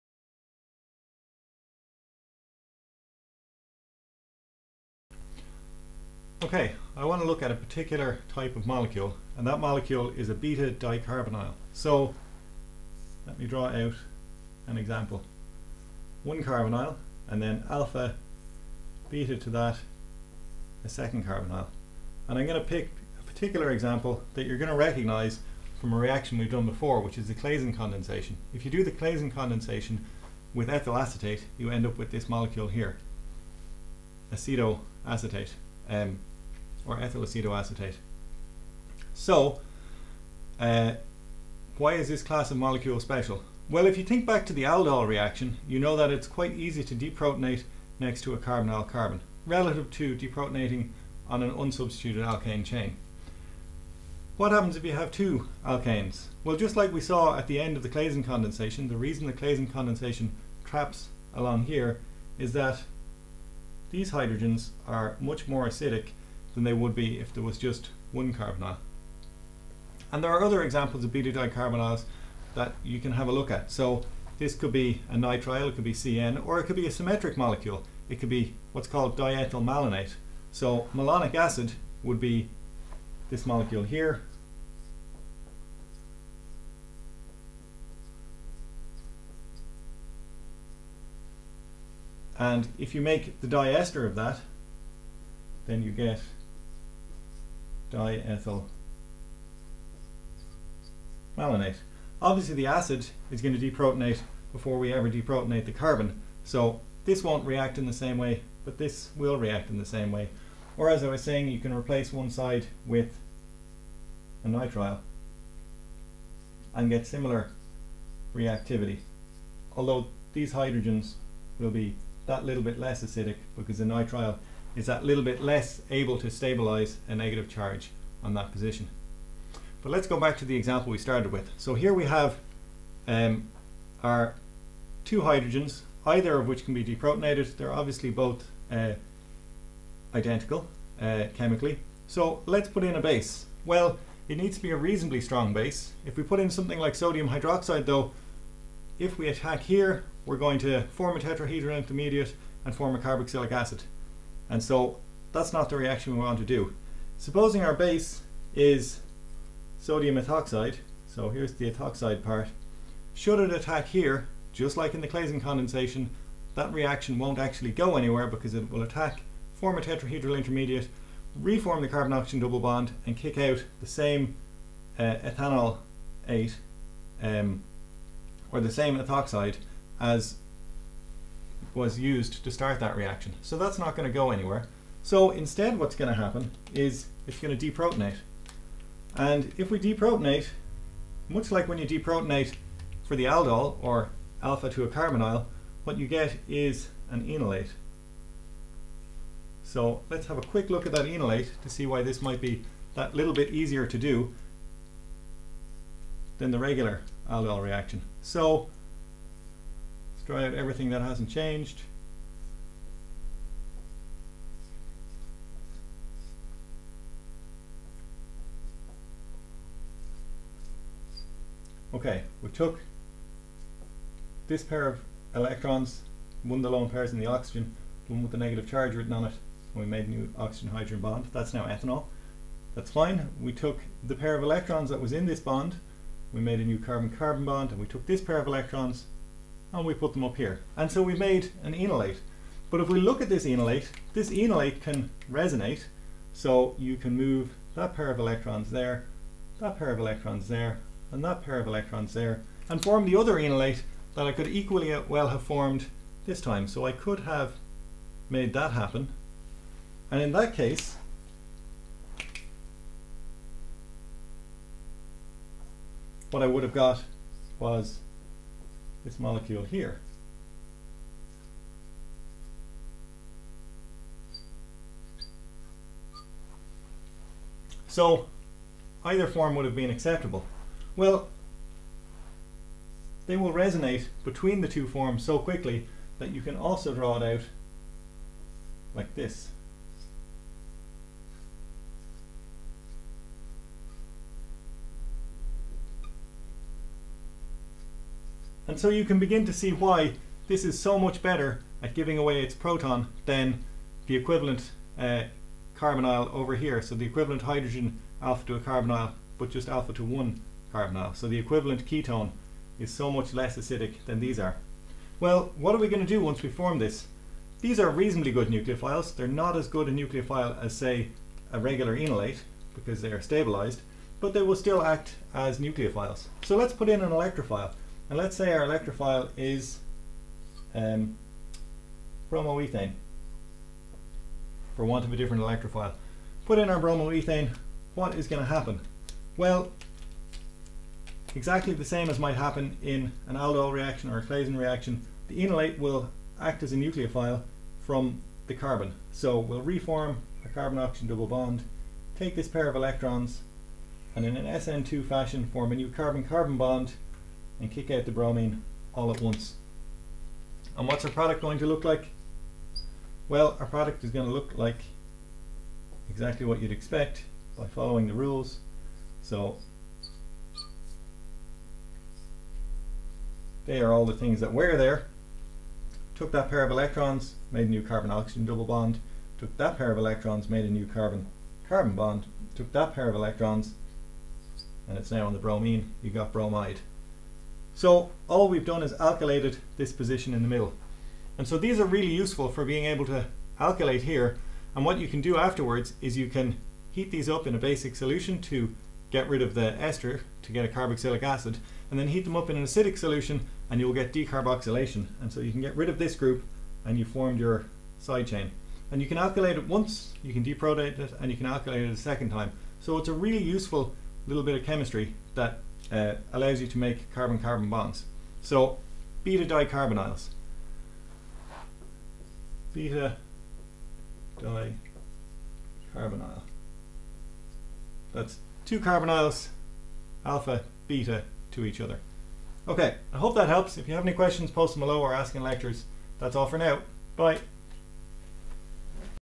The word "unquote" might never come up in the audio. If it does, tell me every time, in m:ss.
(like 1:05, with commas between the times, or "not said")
not said.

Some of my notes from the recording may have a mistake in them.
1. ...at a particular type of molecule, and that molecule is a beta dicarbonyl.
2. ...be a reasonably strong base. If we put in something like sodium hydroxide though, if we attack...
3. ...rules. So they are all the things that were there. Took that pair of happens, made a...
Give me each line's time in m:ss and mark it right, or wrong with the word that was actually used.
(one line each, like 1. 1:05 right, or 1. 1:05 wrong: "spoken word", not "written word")
1. 0:07 right
2. 2:24 right
3. 6:08 wrong: "electrons", not "happens".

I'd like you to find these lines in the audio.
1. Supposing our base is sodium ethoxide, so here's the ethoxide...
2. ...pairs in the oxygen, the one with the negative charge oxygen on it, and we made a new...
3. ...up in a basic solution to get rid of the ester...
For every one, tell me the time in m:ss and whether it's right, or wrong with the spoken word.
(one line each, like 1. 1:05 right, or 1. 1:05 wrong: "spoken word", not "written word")
1. 2:37 right
2. 3:46 wrong: "written", not "oxygen"
3. 6:37 right.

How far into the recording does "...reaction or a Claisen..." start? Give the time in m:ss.
5:43.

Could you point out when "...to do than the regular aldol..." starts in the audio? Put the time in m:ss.
3:23.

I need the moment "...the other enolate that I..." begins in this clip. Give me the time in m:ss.
4:13.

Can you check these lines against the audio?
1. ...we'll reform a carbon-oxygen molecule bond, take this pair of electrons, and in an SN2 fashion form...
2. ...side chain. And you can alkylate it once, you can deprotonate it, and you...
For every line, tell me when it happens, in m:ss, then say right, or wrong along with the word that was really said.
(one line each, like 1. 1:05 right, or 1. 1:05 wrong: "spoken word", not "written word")
1. 5:49 wrong: "double", not "molecule"
2. 6:47 right.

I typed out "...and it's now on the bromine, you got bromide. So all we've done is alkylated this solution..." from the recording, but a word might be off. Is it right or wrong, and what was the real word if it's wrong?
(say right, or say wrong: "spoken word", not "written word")
wrong: "position", not "solution".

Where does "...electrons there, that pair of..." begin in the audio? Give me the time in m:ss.
4:08.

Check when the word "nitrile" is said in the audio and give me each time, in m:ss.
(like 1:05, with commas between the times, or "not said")
1:15, 1:54, 2:03.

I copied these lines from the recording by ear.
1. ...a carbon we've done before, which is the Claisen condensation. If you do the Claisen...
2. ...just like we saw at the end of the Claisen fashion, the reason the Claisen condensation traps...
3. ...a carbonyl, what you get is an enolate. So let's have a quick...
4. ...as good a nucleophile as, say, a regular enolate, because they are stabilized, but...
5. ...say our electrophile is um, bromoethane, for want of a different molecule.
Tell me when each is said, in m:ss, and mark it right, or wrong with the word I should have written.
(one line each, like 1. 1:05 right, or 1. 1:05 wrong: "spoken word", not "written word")
1. 0:25 wrong: "reaction", not "carbon"
2. 0:56 wrong: "condensation", not "fashion"
3. 3:14 right
4. 5:19 right
5. 5:28 wrong: "electrophile", not "molecule".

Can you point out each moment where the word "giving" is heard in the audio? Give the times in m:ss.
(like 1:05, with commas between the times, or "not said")
5:01.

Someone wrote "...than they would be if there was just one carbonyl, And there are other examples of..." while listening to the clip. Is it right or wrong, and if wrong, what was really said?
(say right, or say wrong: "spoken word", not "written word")
right.